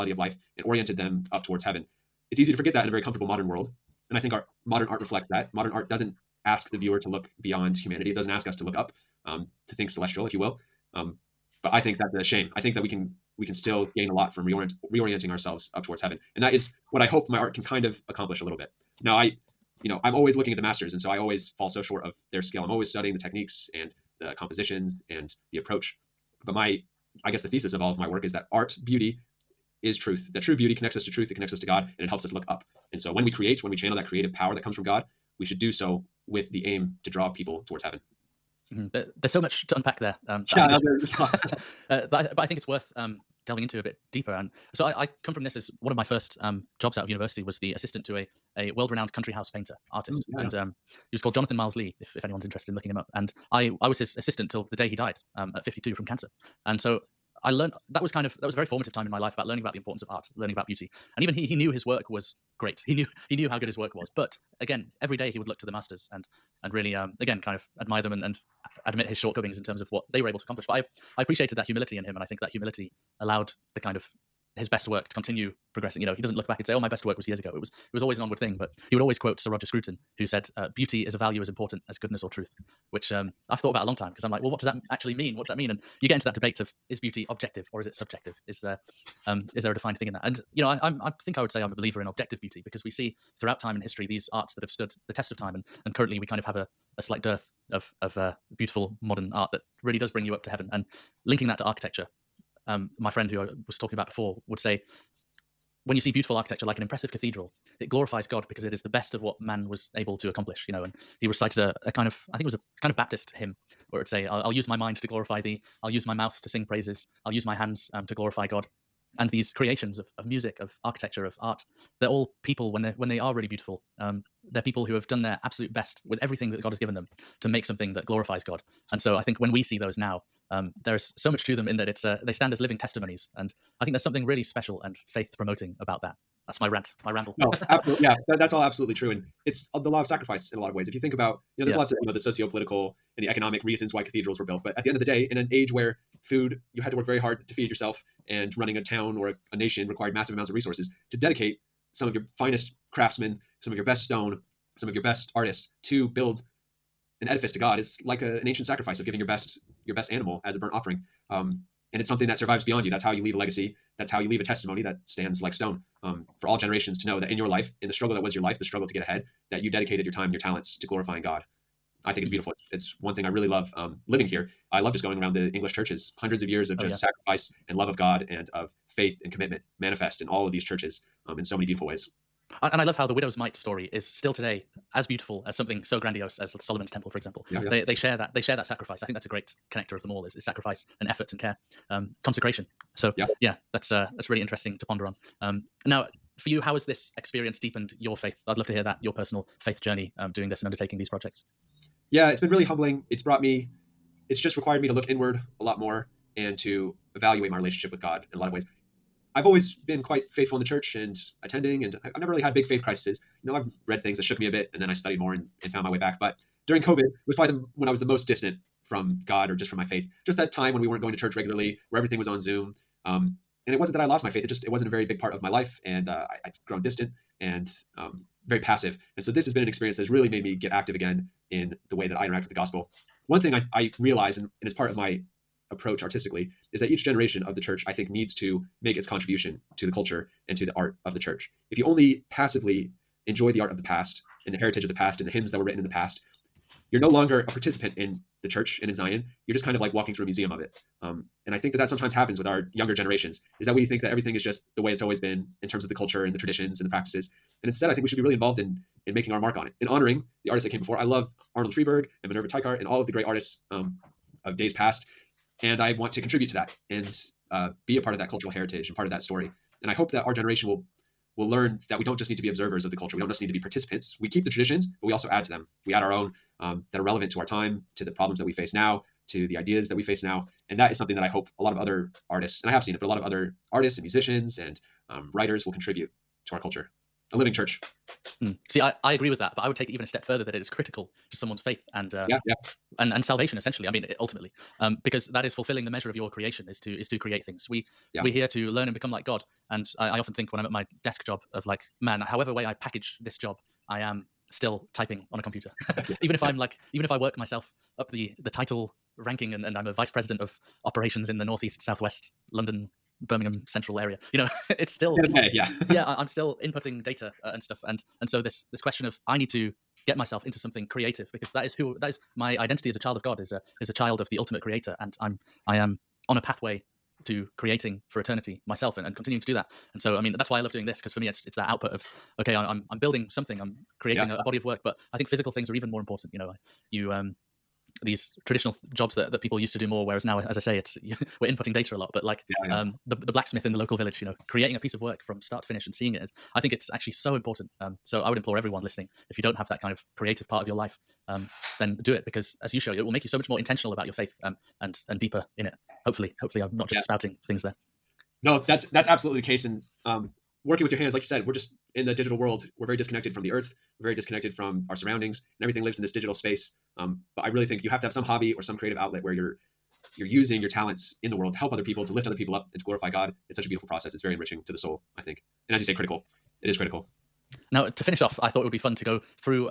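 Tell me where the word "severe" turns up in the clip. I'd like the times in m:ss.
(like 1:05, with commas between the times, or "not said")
not said.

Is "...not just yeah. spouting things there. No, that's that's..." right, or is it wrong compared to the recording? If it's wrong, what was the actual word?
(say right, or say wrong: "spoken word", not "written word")
right.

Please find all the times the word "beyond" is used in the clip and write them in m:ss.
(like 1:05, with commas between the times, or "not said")
0:07, 2:42.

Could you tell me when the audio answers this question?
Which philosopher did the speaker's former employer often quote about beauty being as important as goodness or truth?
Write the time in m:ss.
1:19.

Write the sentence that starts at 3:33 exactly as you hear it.
You know, I've read things that shook me a bit, and then I studied more and, and found my way back.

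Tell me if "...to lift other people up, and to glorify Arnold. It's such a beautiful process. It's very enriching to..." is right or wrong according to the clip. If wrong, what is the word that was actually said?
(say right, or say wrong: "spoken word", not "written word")
wrong: "God", not "Arnold".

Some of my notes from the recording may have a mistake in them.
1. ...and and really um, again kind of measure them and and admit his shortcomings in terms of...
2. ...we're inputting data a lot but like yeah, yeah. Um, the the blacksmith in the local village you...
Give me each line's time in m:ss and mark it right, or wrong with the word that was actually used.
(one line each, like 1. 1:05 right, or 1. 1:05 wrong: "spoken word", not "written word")
1. 1:06 wrong: "admire", not "measure"
2. 5:41 right.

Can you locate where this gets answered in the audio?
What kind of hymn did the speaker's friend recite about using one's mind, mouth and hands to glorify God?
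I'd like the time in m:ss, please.
1:52.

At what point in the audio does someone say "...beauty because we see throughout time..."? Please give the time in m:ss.
1:32.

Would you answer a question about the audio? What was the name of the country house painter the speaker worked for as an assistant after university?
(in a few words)
Jonathan Myles-Lea.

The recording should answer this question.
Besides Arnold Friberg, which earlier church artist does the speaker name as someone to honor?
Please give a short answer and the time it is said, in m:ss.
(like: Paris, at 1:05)
Minerva Teichert, at 4:22.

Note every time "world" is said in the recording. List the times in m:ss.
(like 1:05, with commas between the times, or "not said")
0:03, 0:48, 6:02, 6:11.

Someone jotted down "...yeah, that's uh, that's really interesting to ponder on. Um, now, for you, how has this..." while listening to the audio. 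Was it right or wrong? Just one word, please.
right.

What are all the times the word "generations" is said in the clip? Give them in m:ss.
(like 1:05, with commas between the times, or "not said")
2:46, 3:57, 4:12, 4:30.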